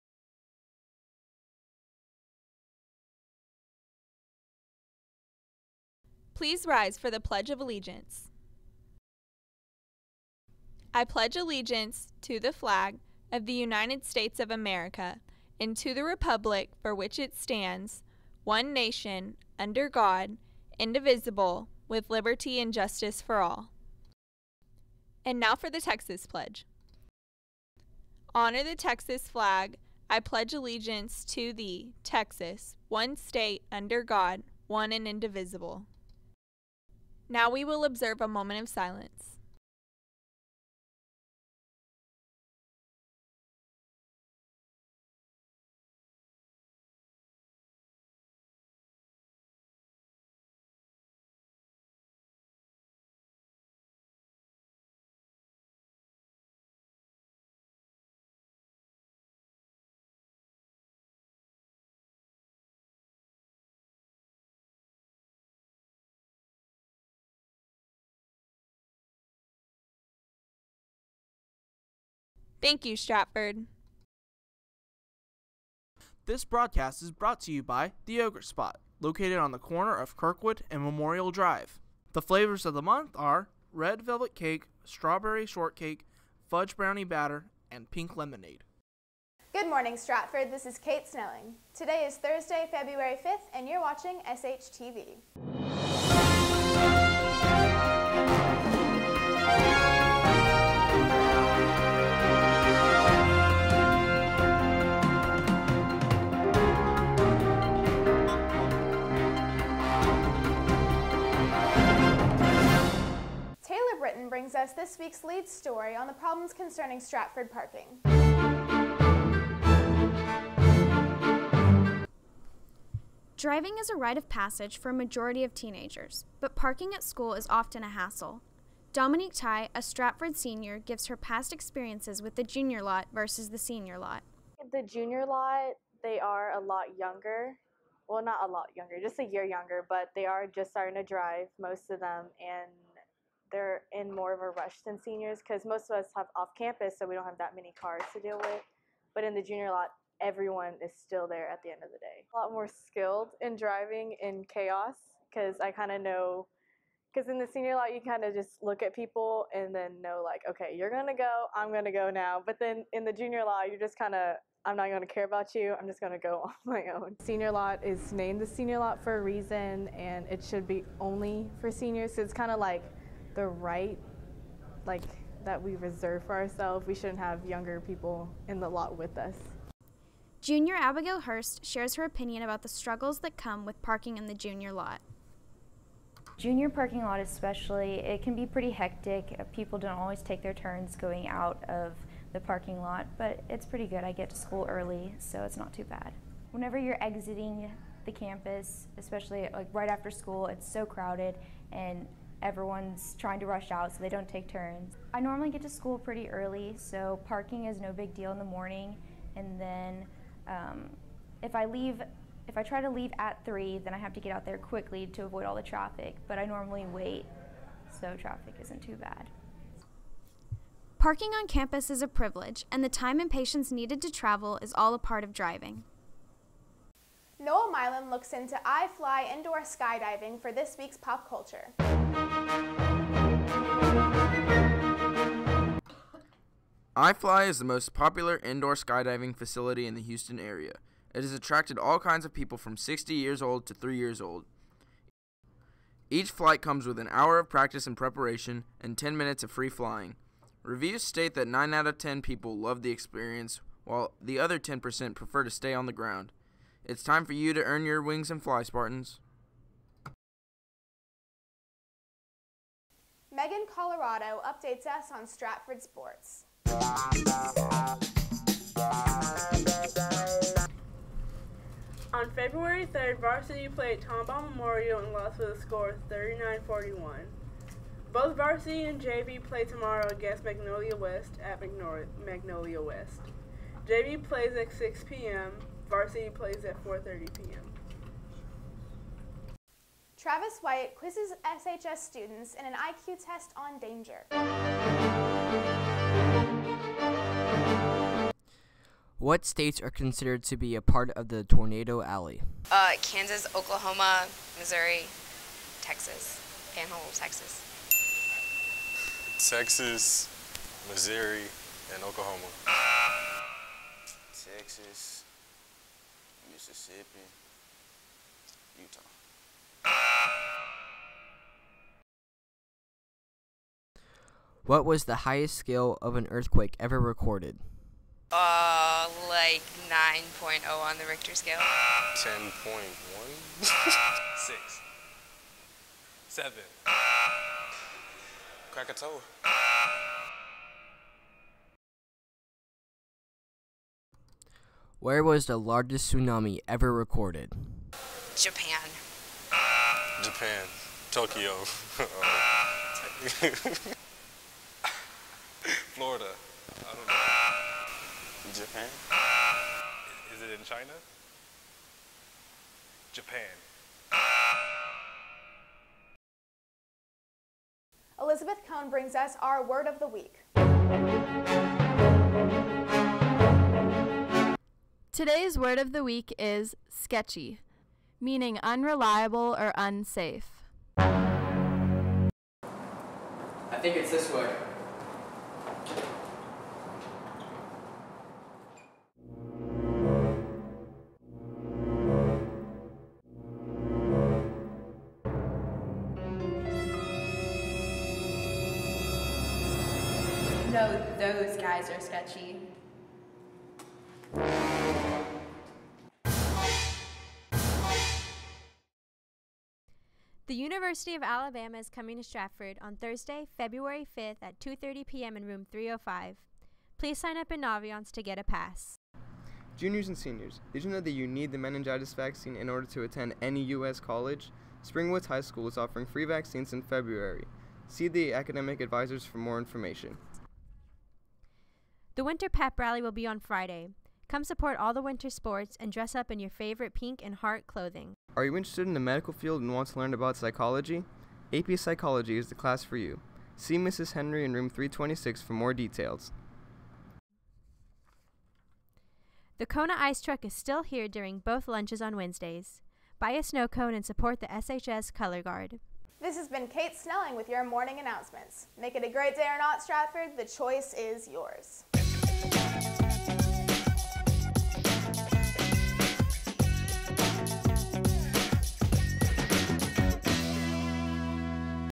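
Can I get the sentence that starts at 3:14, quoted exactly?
I get to school early, so it's not too bad.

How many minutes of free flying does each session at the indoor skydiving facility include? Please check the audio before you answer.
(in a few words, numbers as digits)
10.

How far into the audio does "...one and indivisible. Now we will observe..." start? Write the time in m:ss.
0:34.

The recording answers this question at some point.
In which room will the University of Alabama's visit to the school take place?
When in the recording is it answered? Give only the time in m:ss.
6:55.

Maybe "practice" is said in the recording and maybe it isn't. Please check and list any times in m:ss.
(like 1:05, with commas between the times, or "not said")
4:07.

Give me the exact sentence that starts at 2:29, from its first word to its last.
But in the junior lot, everyone is still there at the end of the day.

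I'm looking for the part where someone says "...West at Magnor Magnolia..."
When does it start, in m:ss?
4:40.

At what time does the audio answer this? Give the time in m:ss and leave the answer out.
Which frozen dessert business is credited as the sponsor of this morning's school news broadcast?
1:18.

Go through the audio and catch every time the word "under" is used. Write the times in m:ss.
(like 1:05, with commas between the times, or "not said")
0:19, 0:33.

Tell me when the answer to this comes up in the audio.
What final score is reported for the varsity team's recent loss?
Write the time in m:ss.
4:36.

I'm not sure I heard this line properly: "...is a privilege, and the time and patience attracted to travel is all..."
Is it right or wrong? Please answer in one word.
wrong.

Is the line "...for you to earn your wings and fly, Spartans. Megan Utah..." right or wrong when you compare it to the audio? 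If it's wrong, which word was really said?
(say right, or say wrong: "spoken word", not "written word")
wrong: "Colorado", not "Utah".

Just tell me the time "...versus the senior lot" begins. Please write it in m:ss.
2:13.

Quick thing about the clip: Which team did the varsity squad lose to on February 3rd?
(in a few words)
Tomball Memorial.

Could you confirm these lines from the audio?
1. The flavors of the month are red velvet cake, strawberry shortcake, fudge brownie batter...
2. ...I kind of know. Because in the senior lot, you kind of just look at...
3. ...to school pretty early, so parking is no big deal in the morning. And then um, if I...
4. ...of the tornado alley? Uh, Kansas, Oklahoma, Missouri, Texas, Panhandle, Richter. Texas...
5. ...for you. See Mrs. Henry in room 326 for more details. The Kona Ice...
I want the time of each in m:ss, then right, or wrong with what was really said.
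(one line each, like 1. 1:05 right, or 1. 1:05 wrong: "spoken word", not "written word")
1. 1:22 right
2. 2:35 right
3. 3:25 right
4. 5:01 wrong: "Texas", not "Richter"
5. 7:22 right.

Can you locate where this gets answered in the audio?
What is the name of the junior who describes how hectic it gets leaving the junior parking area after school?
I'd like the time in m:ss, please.
3:00.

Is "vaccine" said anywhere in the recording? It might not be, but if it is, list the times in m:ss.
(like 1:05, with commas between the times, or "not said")
7:02, 7:06.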